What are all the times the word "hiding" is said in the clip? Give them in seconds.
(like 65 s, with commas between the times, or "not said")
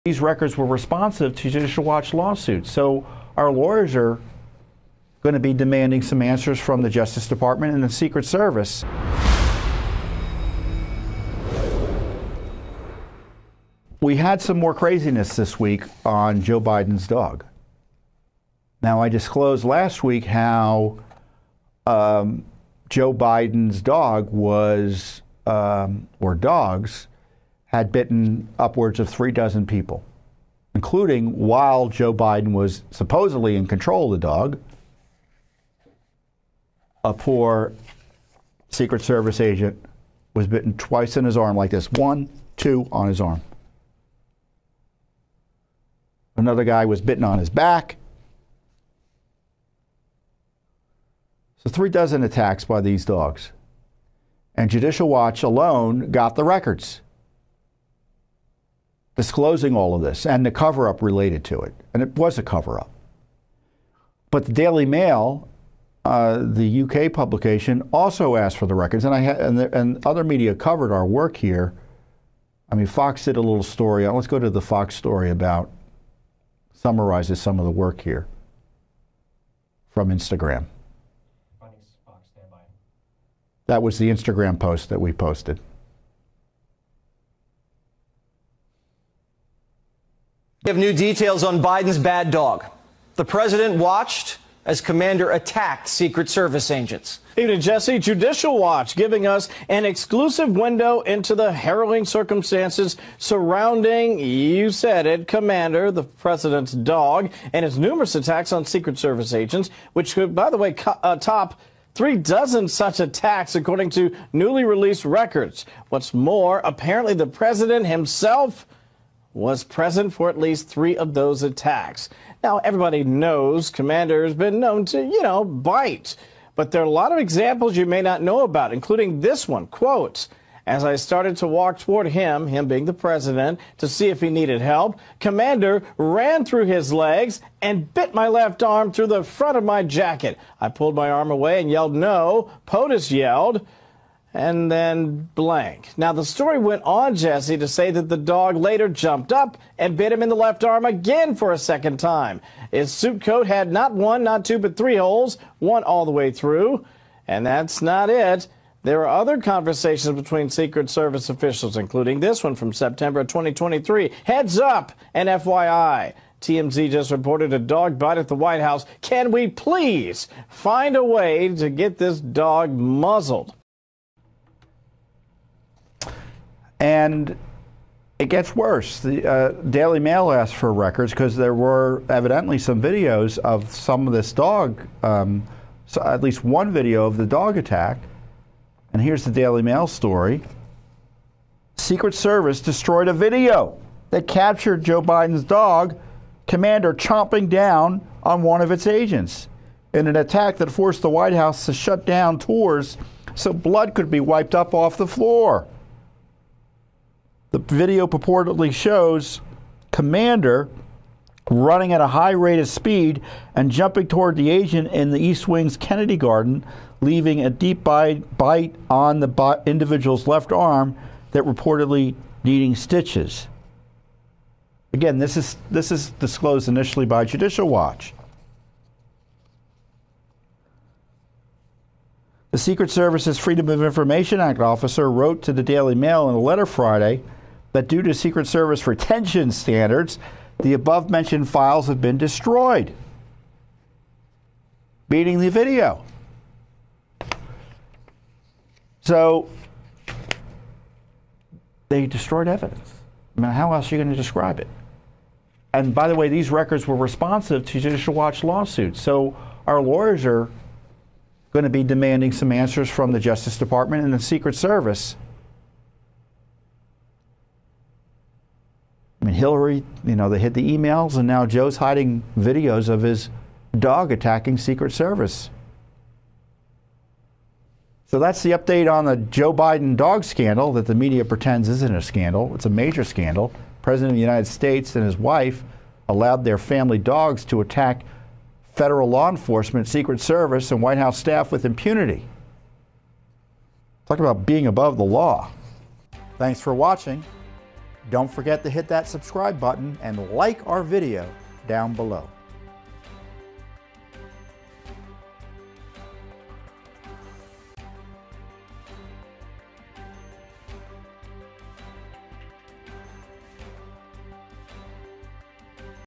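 271 s.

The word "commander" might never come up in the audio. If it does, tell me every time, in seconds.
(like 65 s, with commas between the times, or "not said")
94 s, 105 s, 123 s, 135 s, 196 s, 209 s.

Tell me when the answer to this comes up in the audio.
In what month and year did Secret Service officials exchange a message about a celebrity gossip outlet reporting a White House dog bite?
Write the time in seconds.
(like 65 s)
162 s.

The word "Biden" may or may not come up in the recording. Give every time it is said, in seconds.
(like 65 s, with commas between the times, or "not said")
16 s, 23 s, 32 s, 91 s, 195 s, 279 s.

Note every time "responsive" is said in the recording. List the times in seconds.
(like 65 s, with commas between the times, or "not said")
0 s, 256 s.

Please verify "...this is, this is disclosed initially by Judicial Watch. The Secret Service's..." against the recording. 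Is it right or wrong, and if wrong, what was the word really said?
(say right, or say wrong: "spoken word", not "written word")
right.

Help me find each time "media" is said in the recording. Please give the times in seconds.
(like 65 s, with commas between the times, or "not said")
70 s, 280 s.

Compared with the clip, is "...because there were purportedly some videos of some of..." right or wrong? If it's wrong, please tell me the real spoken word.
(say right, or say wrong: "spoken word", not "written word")
wrong: "evidently", not "purportedly".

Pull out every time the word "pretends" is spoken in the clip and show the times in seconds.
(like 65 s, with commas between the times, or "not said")
281 s.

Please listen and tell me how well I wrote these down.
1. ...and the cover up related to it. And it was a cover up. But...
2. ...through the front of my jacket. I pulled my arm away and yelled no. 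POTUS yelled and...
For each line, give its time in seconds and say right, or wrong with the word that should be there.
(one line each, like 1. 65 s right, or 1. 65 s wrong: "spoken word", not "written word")
1. 60 s right
2. 138 s right.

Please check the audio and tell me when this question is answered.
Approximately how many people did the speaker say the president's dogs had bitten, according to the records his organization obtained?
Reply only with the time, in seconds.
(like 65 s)
29 s.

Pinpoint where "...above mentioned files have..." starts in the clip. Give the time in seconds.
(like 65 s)
240 s.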